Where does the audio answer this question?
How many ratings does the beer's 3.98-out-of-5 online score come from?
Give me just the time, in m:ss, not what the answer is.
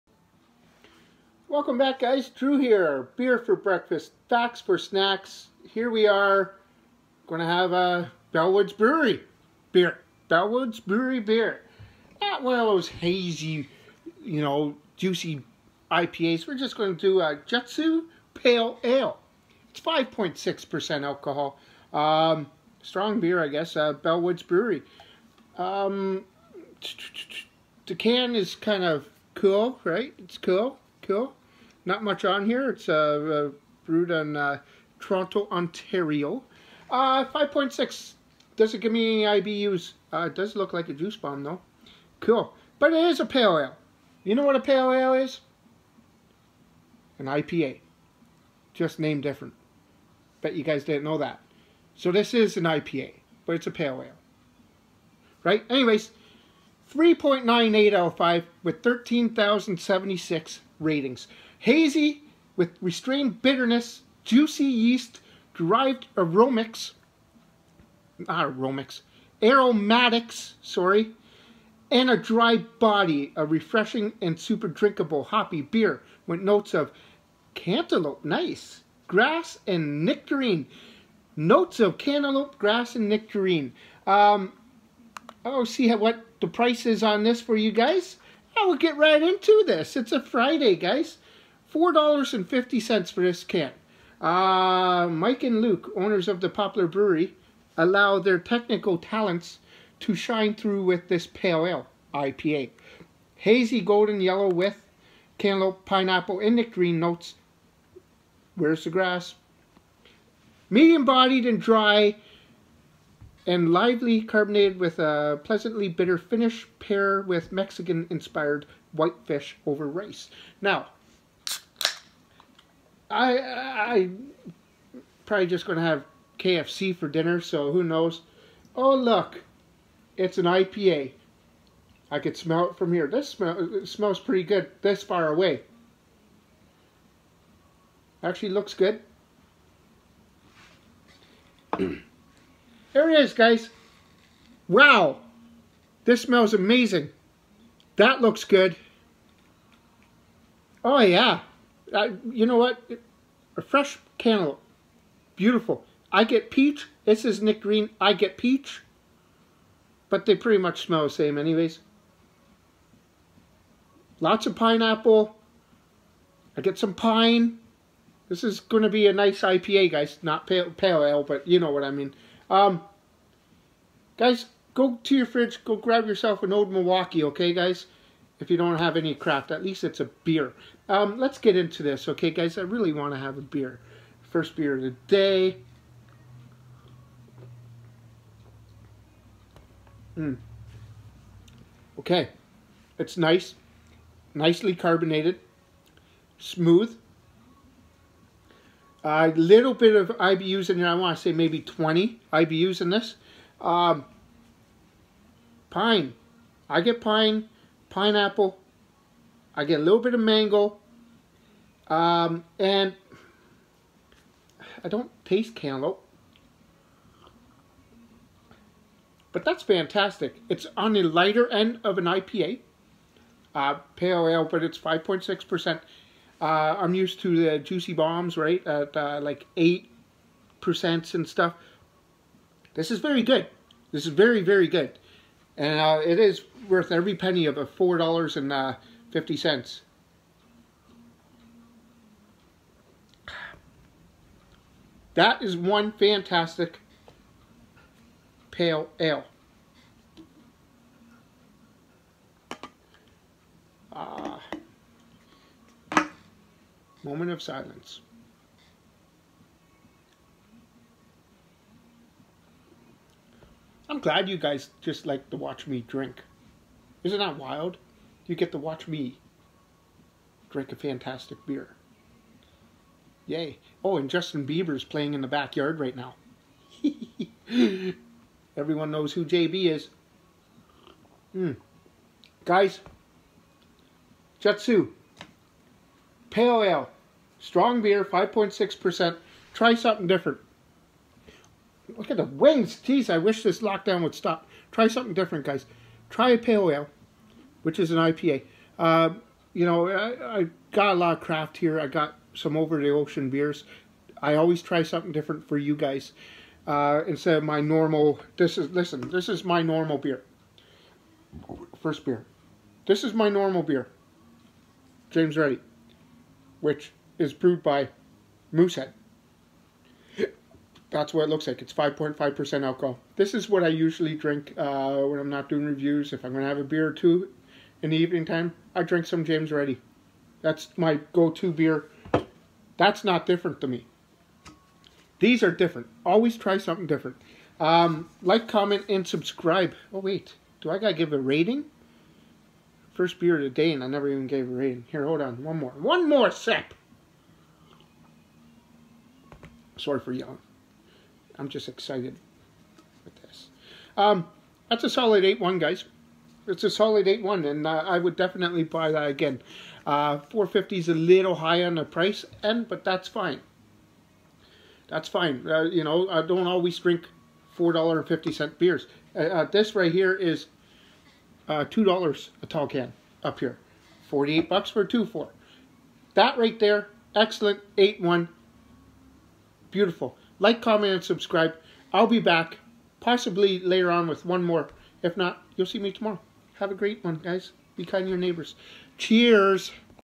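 0:58.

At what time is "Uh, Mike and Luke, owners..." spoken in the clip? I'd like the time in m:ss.
1:34.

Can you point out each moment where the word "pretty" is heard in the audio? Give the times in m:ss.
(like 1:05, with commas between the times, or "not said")
2:14, 2:40.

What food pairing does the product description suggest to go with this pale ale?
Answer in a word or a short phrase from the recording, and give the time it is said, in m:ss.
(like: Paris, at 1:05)
Mexican inspired whitefish over rice, at 1:57.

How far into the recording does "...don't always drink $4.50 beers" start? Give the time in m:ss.
6:06.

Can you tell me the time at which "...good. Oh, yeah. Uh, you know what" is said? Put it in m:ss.
2:28.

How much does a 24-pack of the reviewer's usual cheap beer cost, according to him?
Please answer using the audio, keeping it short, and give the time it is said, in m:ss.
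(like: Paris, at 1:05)
$48, at 6:14.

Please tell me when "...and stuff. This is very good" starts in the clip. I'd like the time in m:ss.
3:51.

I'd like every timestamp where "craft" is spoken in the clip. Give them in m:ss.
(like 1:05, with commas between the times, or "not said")
2:59, 5:01.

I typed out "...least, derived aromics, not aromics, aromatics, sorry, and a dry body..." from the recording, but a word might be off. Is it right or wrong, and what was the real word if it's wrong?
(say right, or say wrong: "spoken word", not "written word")
wrong: "yeast", not "least".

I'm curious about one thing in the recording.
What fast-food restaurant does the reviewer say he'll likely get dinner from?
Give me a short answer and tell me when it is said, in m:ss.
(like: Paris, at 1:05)
KFC, at 2:06.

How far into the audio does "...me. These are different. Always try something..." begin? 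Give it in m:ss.
5:33.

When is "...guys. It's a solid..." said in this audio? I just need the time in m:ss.
5:55.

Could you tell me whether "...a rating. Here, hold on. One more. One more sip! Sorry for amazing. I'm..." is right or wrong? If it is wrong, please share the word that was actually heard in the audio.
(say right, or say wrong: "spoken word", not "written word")
wrong: "yelling", not "amazing".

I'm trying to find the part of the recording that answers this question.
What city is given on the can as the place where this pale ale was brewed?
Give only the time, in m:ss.
0:34.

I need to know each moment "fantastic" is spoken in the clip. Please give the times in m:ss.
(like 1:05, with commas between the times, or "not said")
3:39, 4:05, 4:30.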